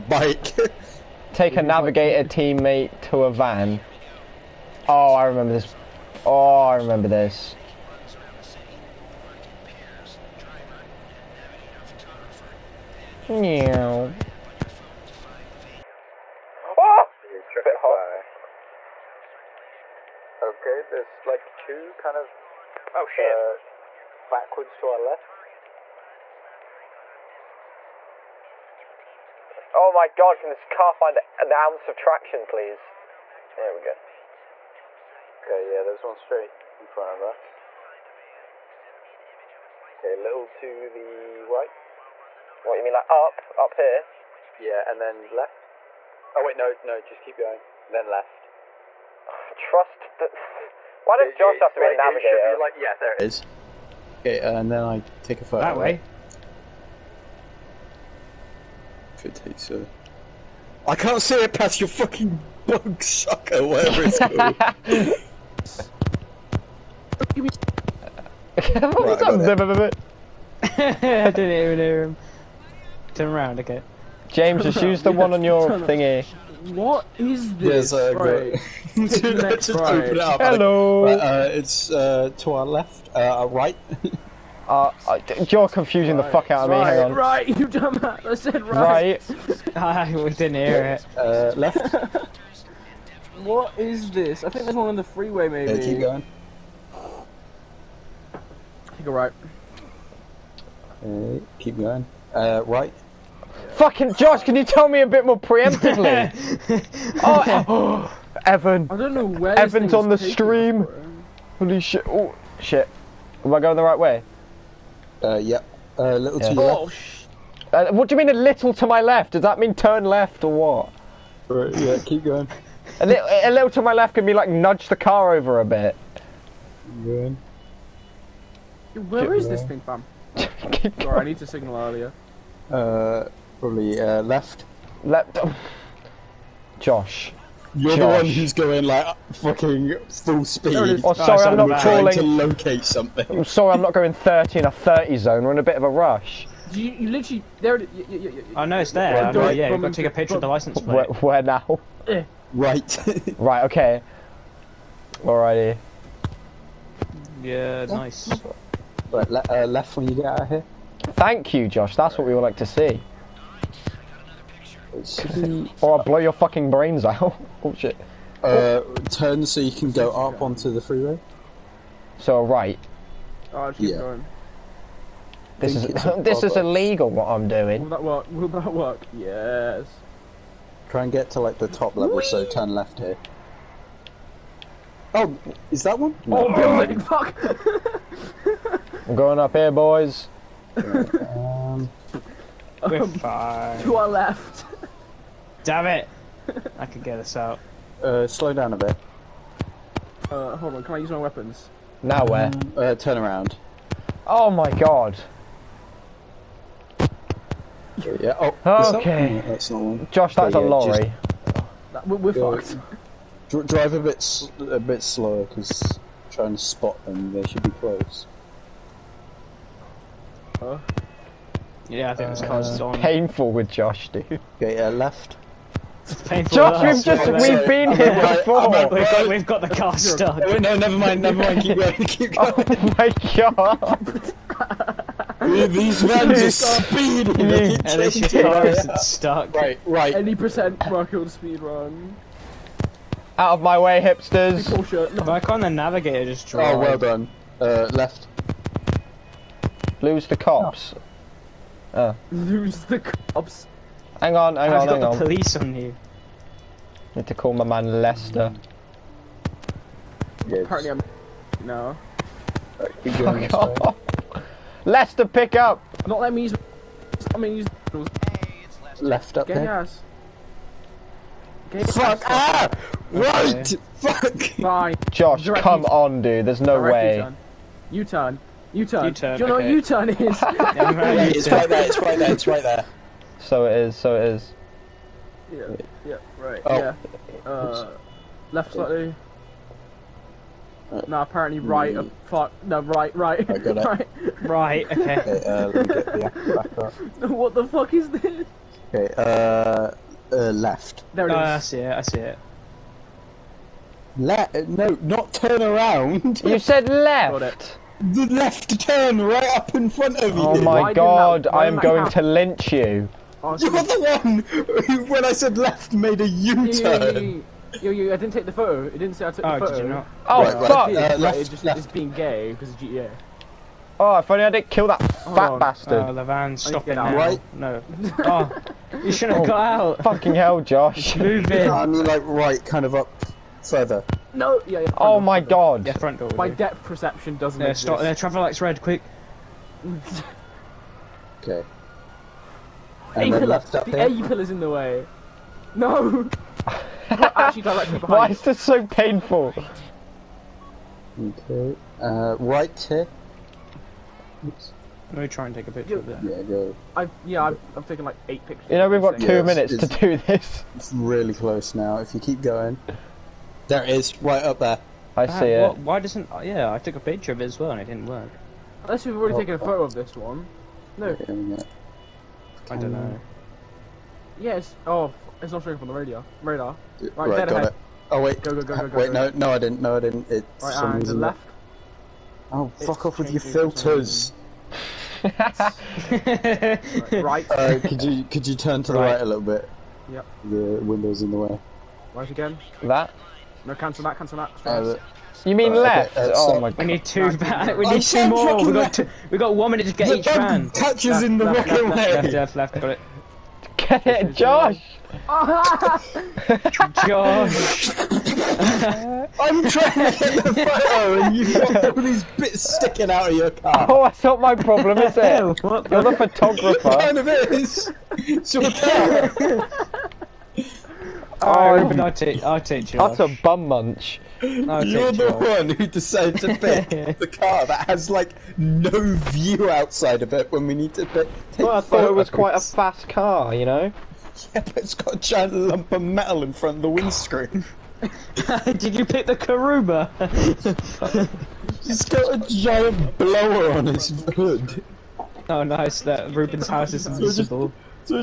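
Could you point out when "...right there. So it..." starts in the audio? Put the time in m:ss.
4:42.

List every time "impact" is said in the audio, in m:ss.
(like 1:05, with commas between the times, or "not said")
not said.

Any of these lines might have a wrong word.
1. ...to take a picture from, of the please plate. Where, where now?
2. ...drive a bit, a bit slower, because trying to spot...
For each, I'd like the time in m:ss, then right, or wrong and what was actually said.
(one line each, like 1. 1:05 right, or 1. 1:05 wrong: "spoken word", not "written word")
1. 2:29 wrong: "license", not "please"
2. 3:33 right.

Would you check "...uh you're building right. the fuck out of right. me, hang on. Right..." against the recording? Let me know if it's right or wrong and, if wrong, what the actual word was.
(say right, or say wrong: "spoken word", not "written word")
wrong: "confusing", not "building".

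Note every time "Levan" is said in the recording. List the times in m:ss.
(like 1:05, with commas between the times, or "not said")
5:26.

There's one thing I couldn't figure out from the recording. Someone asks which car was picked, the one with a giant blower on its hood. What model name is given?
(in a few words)
Karuba.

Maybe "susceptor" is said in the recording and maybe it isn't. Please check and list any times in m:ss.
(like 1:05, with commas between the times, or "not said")
not said.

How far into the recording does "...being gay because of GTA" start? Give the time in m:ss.
5:21.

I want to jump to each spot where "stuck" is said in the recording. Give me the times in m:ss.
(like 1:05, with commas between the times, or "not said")
3:49, 3:58.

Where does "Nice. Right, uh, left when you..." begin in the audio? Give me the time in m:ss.
2:37.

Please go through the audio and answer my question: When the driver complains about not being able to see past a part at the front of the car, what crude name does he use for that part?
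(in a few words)
bug sucker.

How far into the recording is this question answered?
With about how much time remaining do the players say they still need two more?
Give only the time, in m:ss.
6:39.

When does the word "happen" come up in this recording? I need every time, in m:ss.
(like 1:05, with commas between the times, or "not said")
5:12.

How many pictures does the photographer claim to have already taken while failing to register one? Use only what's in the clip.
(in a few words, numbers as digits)
8.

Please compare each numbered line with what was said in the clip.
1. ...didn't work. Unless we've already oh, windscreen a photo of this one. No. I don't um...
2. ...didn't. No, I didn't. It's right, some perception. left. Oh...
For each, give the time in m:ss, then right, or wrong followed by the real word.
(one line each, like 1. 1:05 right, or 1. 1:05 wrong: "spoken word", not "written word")
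1. 6:07 wrong: "taken", not "windscreen"
2. 6:19 wrong: "reason", not "perception".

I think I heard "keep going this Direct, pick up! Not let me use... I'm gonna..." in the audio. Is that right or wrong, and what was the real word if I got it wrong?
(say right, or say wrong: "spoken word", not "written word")
wrong: "Lester", not "Direct".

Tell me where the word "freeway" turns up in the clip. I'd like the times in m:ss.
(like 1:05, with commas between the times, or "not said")
1:35, 2:50.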